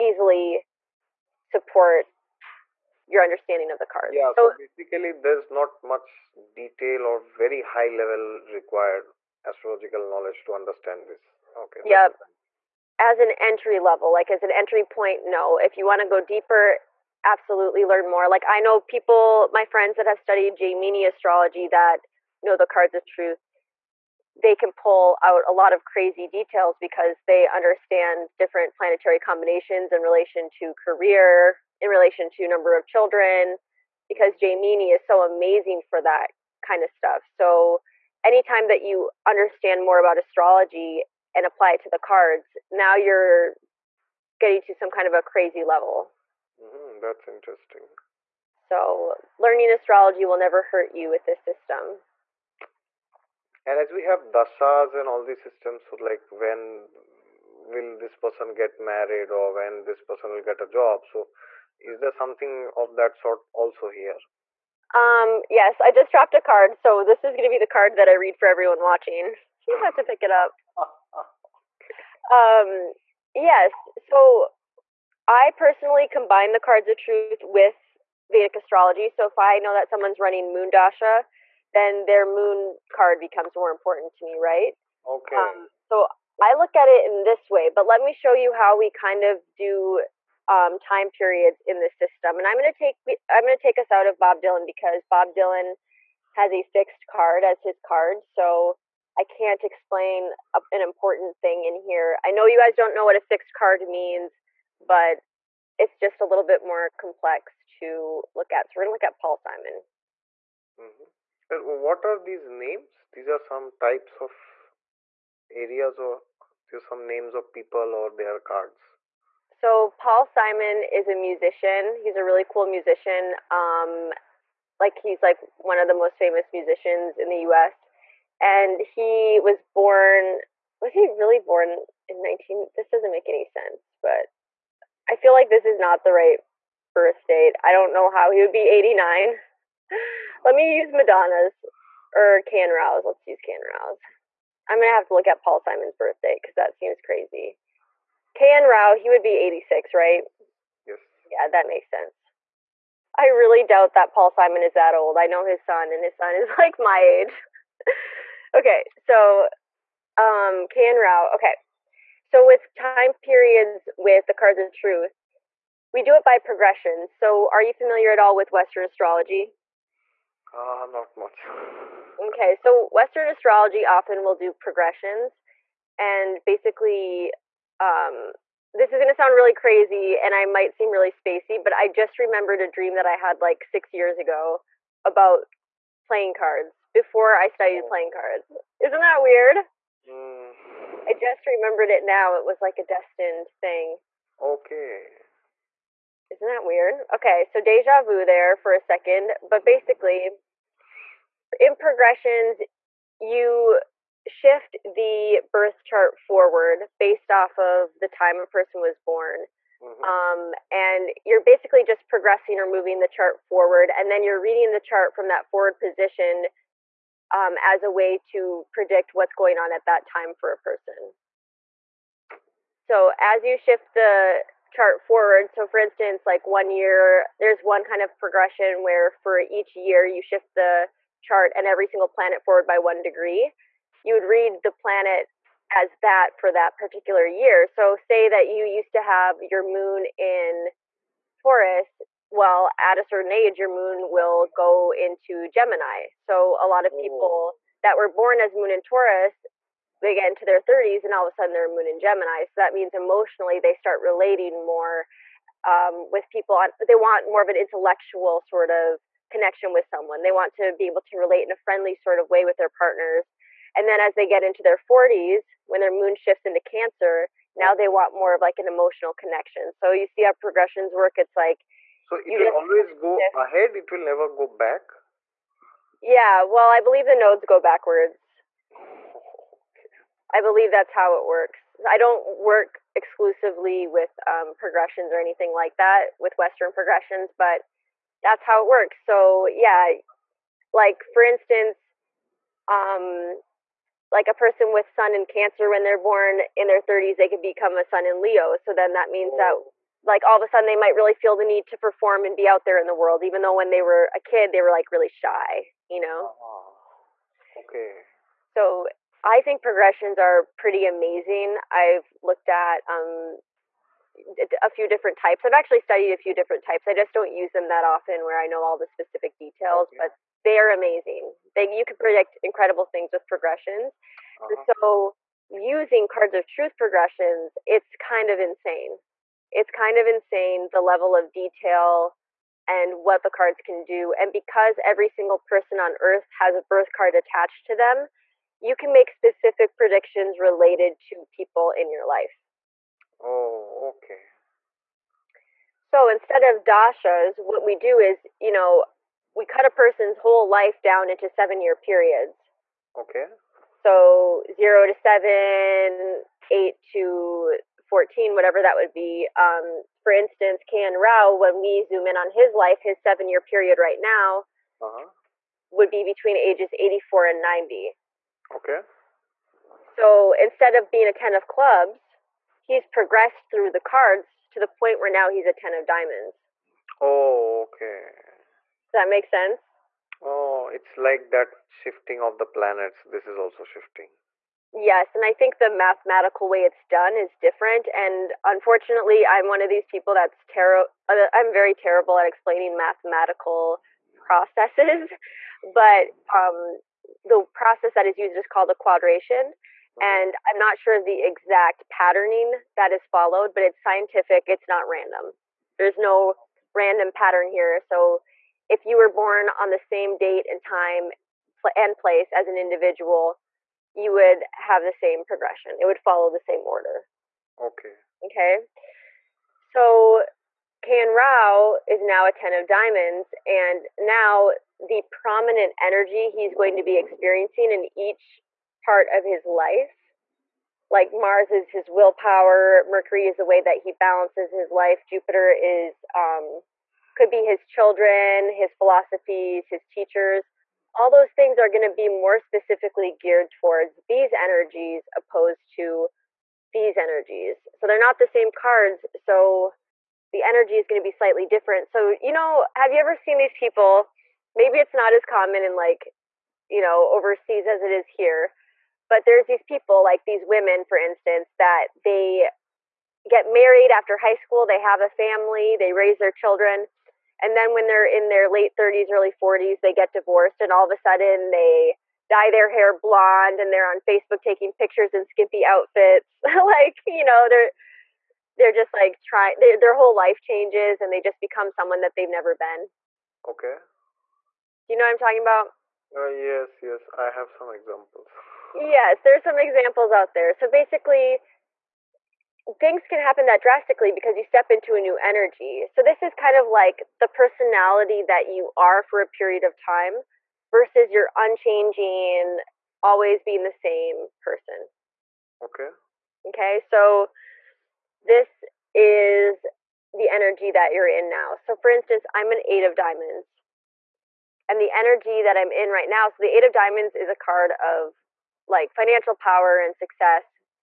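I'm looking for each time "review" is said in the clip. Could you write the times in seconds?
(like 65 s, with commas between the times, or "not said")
not said.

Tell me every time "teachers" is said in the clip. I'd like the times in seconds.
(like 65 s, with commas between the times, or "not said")
439 s.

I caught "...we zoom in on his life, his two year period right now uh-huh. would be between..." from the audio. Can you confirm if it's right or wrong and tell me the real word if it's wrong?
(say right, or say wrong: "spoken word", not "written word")
wrong: "seven", not "two".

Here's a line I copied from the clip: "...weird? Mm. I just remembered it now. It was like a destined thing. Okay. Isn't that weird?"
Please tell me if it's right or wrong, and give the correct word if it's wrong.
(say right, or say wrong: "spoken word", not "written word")
right.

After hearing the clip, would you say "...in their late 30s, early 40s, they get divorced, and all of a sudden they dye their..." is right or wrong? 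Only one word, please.
right.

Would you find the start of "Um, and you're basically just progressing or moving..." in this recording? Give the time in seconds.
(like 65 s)
210 s.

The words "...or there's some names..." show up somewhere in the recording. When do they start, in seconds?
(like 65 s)
115 s.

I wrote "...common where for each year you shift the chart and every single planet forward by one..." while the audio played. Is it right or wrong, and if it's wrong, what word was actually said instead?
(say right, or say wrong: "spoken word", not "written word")
wrong: "progression", not "common".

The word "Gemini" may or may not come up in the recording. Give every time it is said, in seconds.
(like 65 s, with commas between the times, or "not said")
245 s, 251 s.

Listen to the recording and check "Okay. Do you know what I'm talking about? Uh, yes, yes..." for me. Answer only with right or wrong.
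right.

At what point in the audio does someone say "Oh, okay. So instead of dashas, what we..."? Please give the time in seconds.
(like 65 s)
343 s.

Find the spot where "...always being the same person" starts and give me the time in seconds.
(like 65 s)
503 s.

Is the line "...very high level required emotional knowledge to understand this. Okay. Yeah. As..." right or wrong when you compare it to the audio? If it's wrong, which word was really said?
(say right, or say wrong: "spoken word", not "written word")
wrong: "astrological", not "emotional".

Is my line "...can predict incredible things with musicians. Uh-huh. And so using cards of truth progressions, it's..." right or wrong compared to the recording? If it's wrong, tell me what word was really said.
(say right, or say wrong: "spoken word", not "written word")
wrong: "progressions", not "musicians".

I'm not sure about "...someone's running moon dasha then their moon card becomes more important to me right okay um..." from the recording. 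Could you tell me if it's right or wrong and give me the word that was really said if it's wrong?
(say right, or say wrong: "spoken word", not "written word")
right.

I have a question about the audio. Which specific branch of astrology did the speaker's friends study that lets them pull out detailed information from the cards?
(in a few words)
Jaimini astrology.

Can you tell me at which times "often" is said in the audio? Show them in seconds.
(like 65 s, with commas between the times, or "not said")
173 s, 317 s.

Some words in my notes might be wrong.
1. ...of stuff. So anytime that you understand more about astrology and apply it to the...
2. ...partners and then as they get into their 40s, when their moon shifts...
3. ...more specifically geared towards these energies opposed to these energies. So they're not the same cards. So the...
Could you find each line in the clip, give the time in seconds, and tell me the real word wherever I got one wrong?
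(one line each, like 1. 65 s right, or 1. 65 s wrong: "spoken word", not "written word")
1. 36 s right
2. 262 s right
3. 442 s right.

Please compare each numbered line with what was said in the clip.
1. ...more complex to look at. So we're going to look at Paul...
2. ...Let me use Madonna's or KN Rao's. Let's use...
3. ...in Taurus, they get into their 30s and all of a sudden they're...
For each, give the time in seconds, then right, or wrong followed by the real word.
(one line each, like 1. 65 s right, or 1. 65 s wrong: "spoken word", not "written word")
1. 106 s right
2. 140 s right
3. 248 s right.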